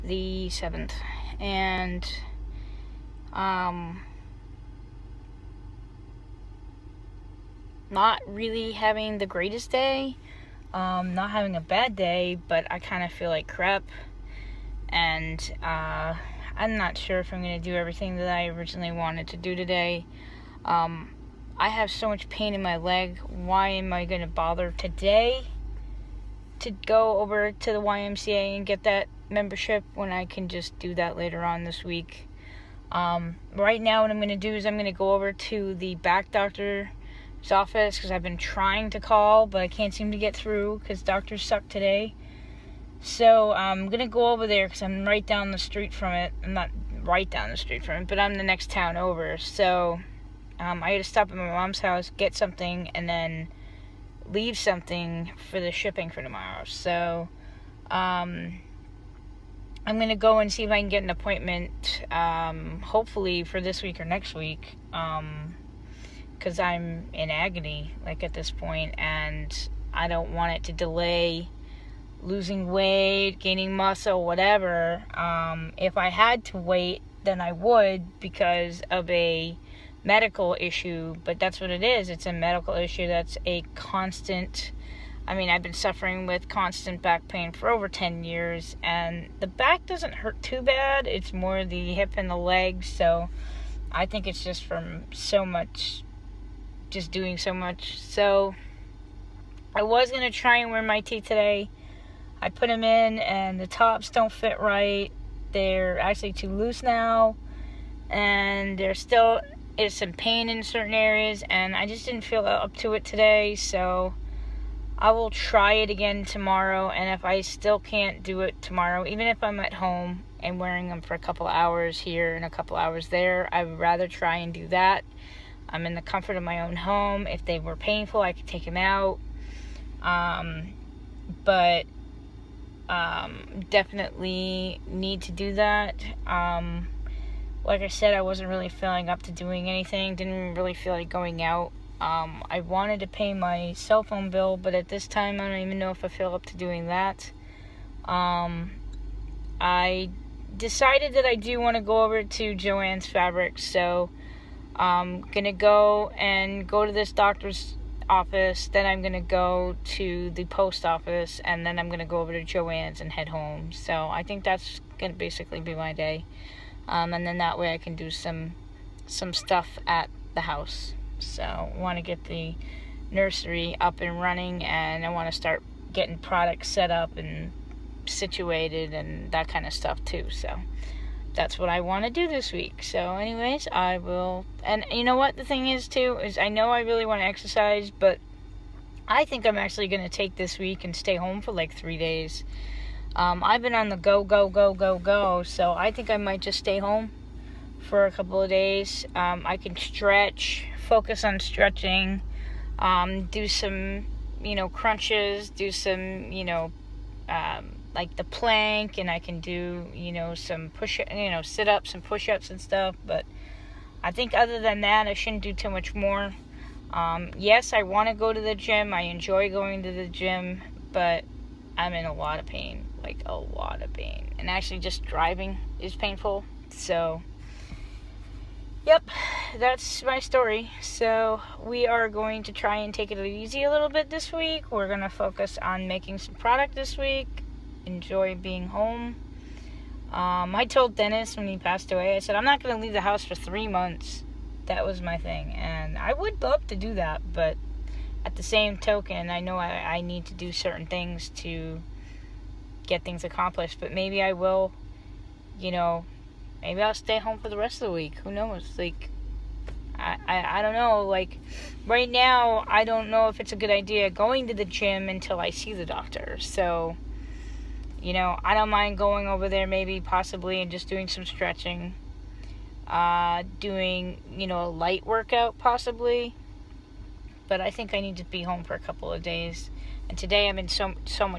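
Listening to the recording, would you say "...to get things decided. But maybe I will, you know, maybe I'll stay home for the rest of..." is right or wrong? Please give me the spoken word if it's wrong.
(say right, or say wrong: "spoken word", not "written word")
wrong: "accomplished", not "decided".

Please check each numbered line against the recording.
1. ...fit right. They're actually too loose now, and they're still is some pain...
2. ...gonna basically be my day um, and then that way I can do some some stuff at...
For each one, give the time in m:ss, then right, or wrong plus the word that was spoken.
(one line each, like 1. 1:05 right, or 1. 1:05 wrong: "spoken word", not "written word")
1. 1:44 right
2. 2:44 right.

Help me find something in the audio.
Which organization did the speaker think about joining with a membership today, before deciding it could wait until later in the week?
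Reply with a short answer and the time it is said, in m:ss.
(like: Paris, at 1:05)
YMCA, at 0:27.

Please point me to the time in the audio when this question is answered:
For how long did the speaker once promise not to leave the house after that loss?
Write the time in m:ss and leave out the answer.
4:03.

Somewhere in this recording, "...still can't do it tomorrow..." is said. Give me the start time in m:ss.
1:57.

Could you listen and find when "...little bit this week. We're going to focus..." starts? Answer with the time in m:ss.
3:53.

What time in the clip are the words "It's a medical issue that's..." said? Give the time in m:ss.
1:22.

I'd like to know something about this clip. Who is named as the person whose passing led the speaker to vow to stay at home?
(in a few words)
Dennis.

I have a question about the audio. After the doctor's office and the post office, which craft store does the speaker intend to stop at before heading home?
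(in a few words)
Jo-Ann's Fabrics.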